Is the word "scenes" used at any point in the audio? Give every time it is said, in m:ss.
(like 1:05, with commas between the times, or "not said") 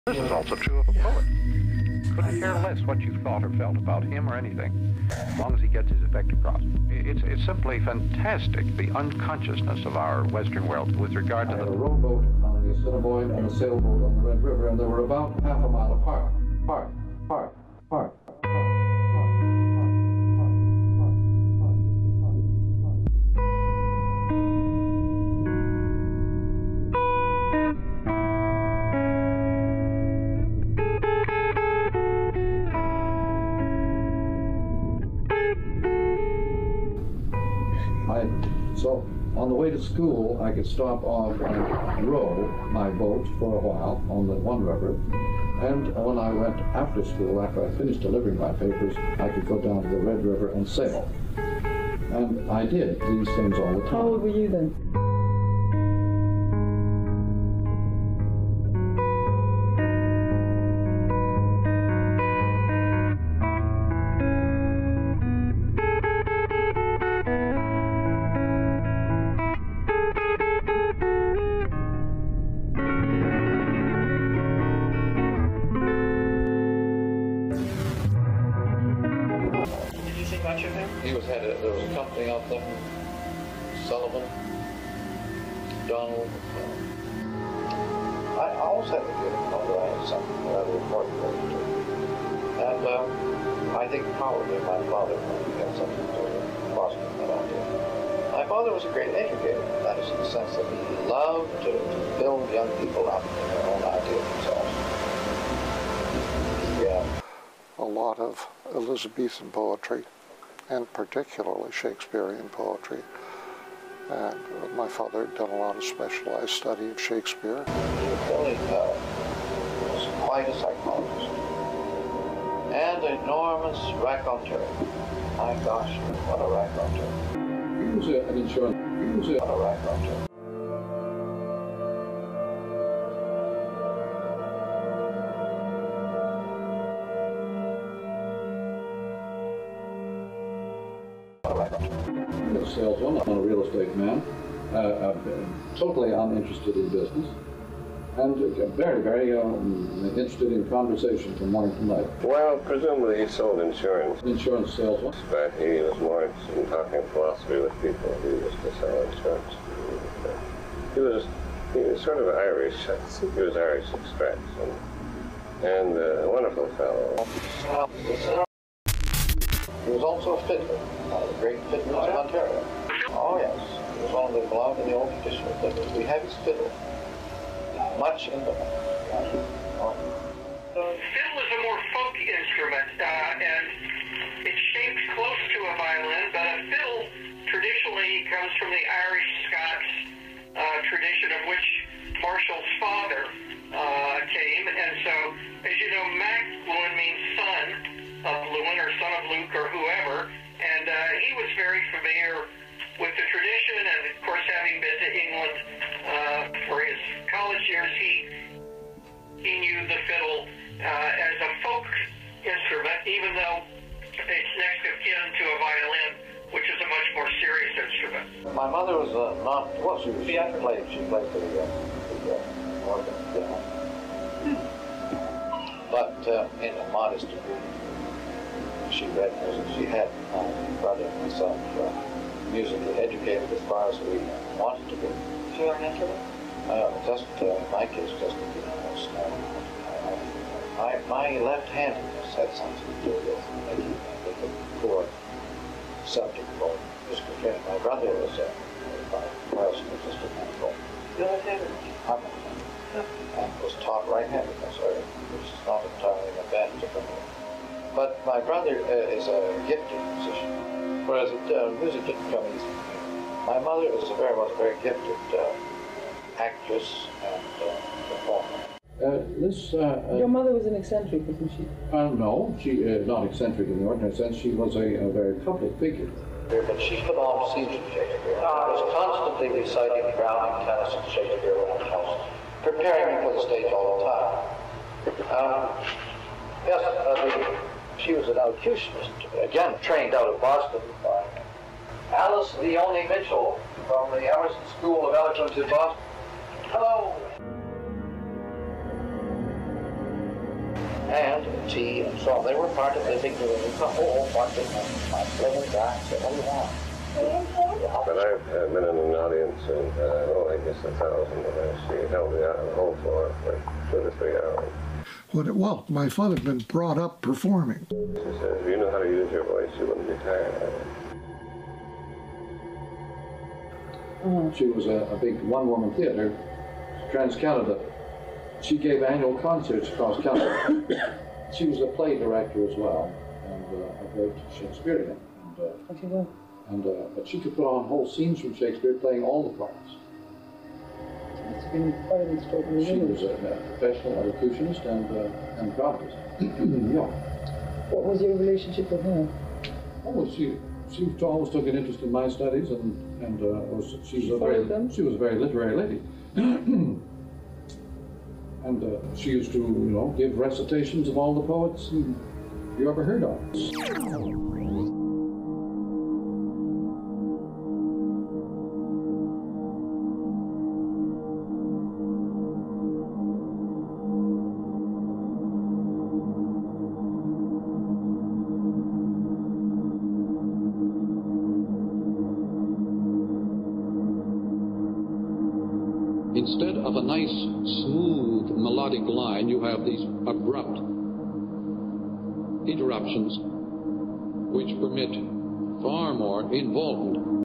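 4:37, 5:38.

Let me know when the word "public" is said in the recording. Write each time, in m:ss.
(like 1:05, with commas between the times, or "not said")
4:35.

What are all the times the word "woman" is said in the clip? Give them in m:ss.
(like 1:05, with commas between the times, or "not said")
5:25.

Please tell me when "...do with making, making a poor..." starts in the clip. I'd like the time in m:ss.
4:03.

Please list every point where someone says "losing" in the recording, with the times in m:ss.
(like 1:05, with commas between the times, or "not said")
not said.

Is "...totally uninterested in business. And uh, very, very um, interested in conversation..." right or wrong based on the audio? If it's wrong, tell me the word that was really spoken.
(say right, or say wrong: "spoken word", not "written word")
right.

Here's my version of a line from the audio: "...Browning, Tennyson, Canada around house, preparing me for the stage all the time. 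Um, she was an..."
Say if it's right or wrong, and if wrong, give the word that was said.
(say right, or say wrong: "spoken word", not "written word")
wrong: "Shakespeare", not "Canada".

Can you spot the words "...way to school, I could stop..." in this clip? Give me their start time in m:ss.
0:39.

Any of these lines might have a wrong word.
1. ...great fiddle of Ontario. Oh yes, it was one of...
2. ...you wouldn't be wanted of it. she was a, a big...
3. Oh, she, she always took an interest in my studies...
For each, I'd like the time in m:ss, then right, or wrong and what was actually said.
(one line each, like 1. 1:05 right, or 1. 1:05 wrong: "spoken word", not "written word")
1. 2:51 right
2. 5:19 wrong: "tired", not "wanted"
3. 5:50 right.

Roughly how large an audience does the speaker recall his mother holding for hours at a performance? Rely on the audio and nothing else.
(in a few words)
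1,000.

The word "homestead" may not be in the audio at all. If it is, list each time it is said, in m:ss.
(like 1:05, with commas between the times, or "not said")
not said.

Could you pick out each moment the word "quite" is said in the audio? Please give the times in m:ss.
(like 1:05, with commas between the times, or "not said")
2:00, 5:42.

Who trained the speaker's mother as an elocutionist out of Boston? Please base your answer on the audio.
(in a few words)
Alice Leone Mitchell.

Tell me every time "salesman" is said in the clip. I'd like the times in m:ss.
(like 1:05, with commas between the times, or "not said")
2:22, 2:34.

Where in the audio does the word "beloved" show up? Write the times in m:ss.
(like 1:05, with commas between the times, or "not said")
2:54.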